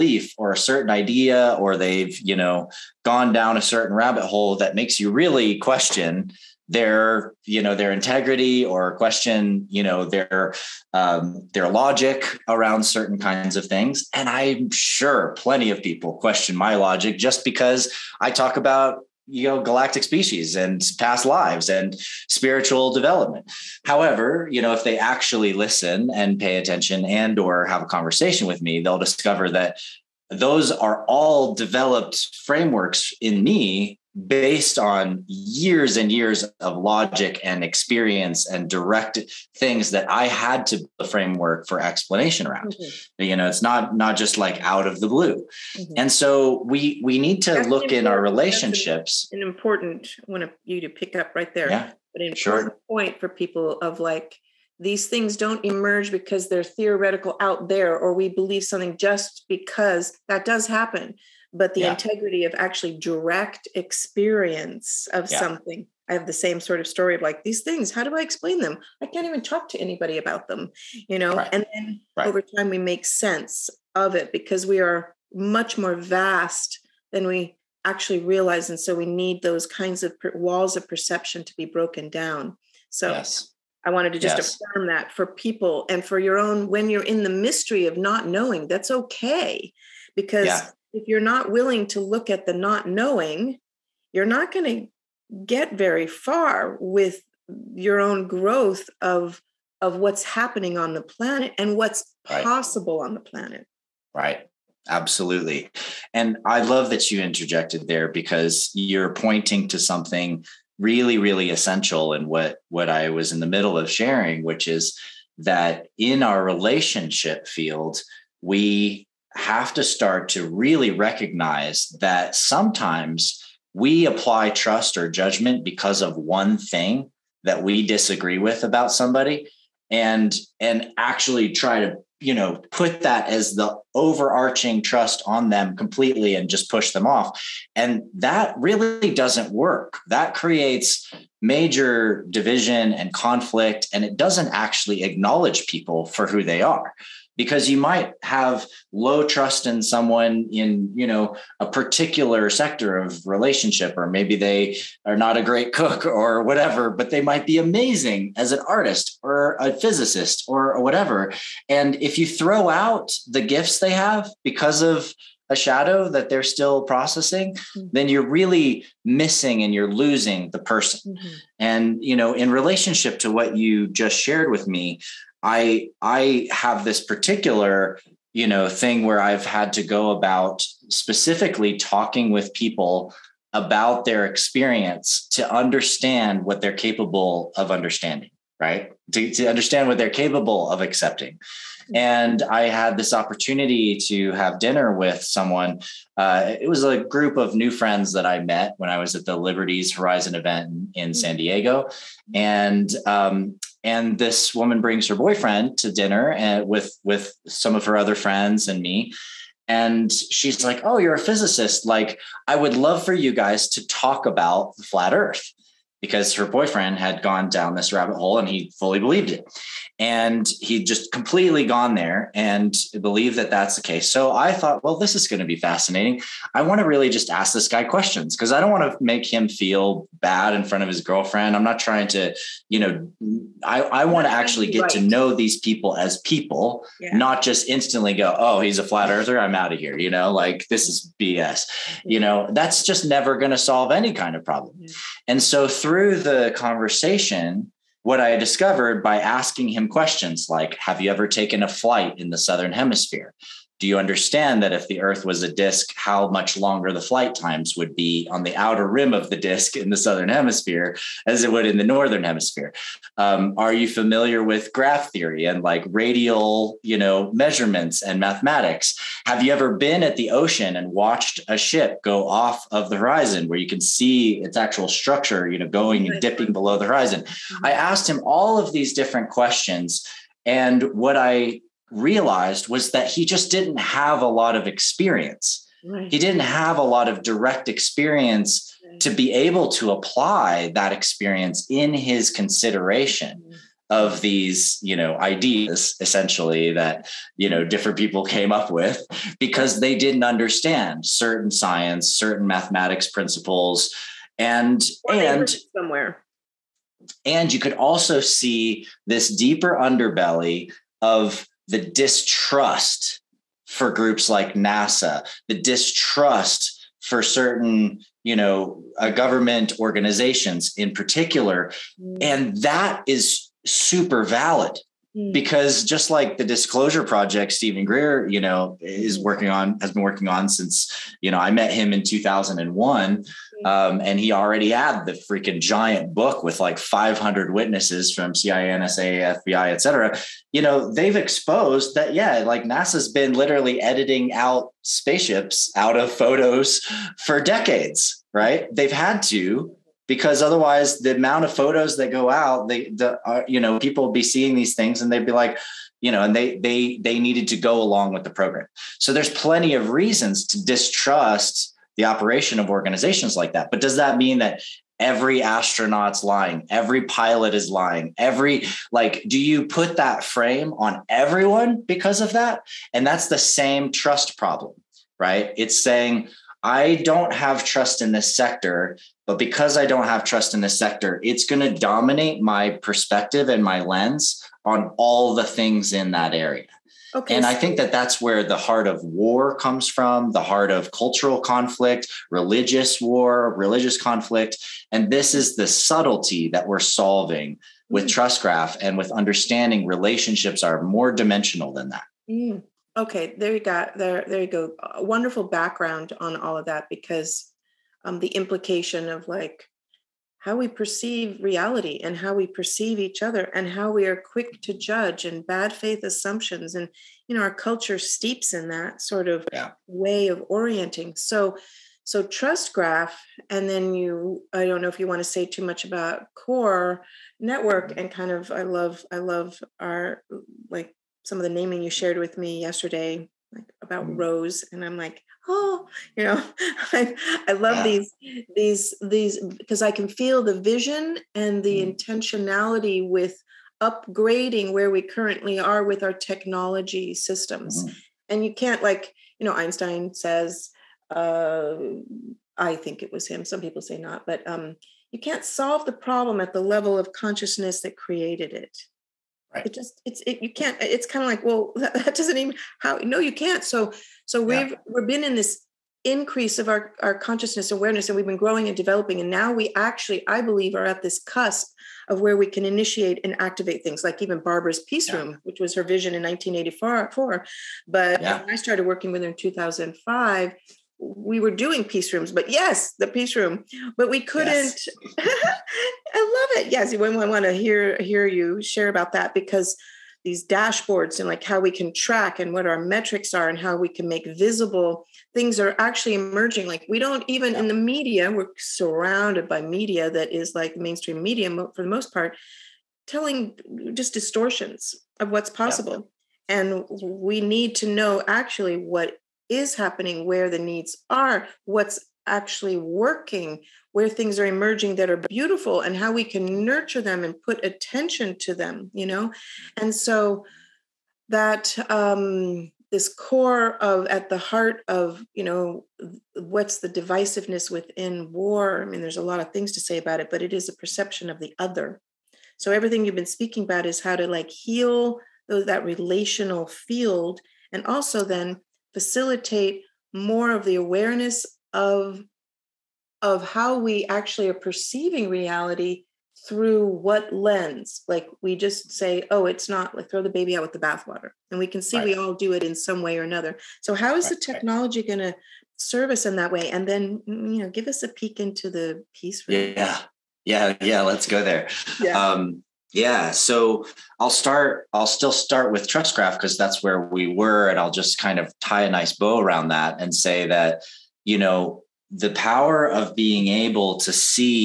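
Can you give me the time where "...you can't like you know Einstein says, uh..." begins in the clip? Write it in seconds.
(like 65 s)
448 s.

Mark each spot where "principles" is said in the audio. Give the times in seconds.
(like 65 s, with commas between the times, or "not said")
303 s.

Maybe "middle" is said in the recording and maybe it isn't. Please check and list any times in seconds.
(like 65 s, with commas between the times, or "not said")
113 s.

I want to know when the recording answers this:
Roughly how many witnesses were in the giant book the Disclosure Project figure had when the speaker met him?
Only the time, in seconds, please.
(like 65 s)
336 s.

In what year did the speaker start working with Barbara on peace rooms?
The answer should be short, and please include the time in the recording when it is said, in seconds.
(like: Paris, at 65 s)
2005, at 479 s.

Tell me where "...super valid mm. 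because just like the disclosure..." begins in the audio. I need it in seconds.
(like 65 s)
323 s.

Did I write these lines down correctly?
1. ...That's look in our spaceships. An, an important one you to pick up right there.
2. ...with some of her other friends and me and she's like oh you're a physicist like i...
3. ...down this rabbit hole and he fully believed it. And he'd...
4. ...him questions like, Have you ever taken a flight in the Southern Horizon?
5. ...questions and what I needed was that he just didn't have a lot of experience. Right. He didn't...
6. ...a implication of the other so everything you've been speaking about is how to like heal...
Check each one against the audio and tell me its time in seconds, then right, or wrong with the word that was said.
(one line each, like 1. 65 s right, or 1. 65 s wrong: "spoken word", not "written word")
1. 47 s wrong: "relationships", not "spaceships"
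2. 207 s right
3. 217 s right
4. 249 s wrong: "Hemisphere", not "Horizon"
5. 279 s wrong: "realized", not "needed"
6. 530 s wrong: "perception", not "implication".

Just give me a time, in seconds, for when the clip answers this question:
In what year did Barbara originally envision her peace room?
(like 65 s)
476 s.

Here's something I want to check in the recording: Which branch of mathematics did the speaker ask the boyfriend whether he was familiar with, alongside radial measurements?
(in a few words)
Graph theory.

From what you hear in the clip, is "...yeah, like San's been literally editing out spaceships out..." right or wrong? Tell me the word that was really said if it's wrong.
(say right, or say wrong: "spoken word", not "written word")
wrong: "NASA", not "San".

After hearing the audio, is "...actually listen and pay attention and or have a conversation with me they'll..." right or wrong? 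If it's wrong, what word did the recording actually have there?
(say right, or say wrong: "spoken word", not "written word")
right.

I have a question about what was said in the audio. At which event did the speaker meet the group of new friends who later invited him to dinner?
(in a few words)
Liberties Horizon.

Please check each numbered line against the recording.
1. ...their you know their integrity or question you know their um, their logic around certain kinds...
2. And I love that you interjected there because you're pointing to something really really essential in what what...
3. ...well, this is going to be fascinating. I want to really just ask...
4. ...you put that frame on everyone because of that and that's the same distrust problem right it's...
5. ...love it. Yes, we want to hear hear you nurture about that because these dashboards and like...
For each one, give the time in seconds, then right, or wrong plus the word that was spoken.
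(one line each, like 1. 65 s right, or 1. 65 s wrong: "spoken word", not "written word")
1. 6 s right
2. 106 s right
3. 224 s right
4. 369 s wrong: "trust", not "distrust"
5. 486 s wrong: "share", not "nurture".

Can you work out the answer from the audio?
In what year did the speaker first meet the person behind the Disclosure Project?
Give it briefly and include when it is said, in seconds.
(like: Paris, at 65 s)
2001, at 332 s.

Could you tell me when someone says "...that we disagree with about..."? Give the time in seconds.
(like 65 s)
127 s.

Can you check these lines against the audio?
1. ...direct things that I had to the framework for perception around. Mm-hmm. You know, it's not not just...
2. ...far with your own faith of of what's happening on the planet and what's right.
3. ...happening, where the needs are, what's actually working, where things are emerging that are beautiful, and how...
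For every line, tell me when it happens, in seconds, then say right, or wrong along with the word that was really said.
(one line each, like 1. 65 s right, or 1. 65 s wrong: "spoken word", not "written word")
1. 38 s wrong: "explanation", not "perception"
2. 96 s wrong: "growth", not "faith"
3. 509 s right.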